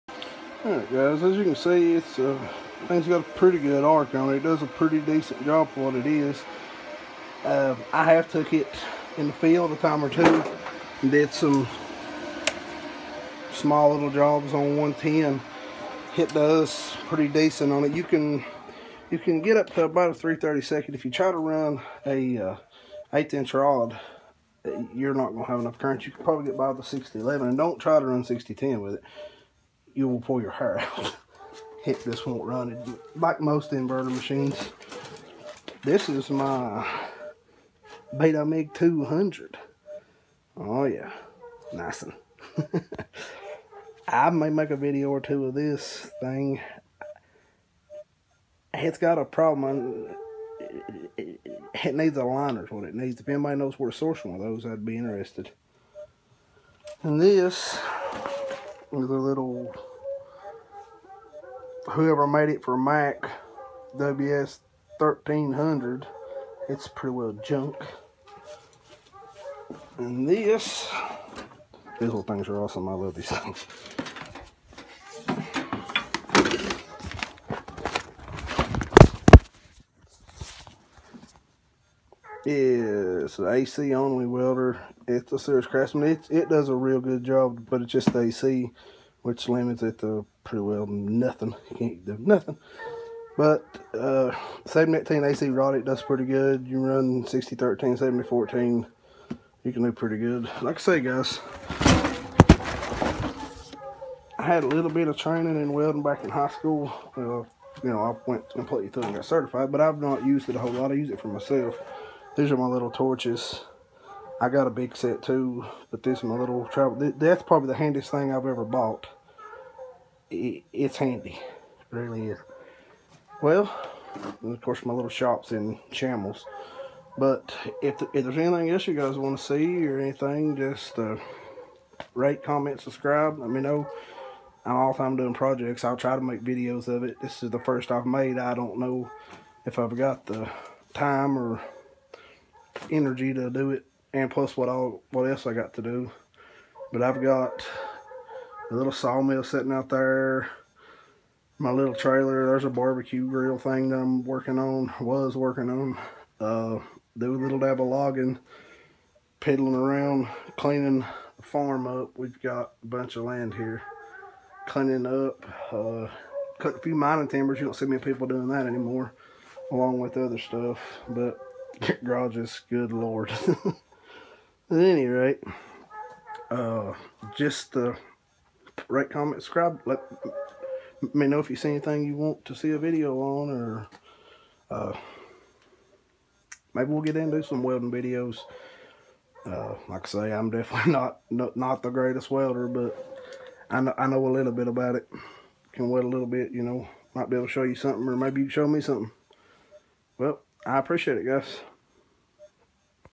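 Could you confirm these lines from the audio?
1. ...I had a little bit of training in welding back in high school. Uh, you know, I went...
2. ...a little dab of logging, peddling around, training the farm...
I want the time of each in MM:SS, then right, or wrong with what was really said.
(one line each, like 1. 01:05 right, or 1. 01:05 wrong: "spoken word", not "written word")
1. 01:44 right
2. 02:37 wrong: "cleaning", not "training".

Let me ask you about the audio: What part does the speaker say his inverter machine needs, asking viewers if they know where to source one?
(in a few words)
A liner.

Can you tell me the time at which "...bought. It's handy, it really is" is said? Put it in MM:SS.
01:58.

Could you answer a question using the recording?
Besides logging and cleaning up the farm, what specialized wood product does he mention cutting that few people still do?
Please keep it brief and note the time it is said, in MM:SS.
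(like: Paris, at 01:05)
Mining timbers, at 02:46.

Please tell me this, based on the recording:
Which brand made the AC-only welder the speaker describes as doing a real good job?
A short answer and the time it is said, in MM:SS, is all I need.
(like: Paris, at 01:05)
Sears Craftsman, at 01:25.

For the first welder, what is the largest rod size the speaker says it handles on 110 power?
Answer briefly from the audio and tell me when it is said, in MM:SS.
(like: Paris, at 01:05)
3/32, at 00:20.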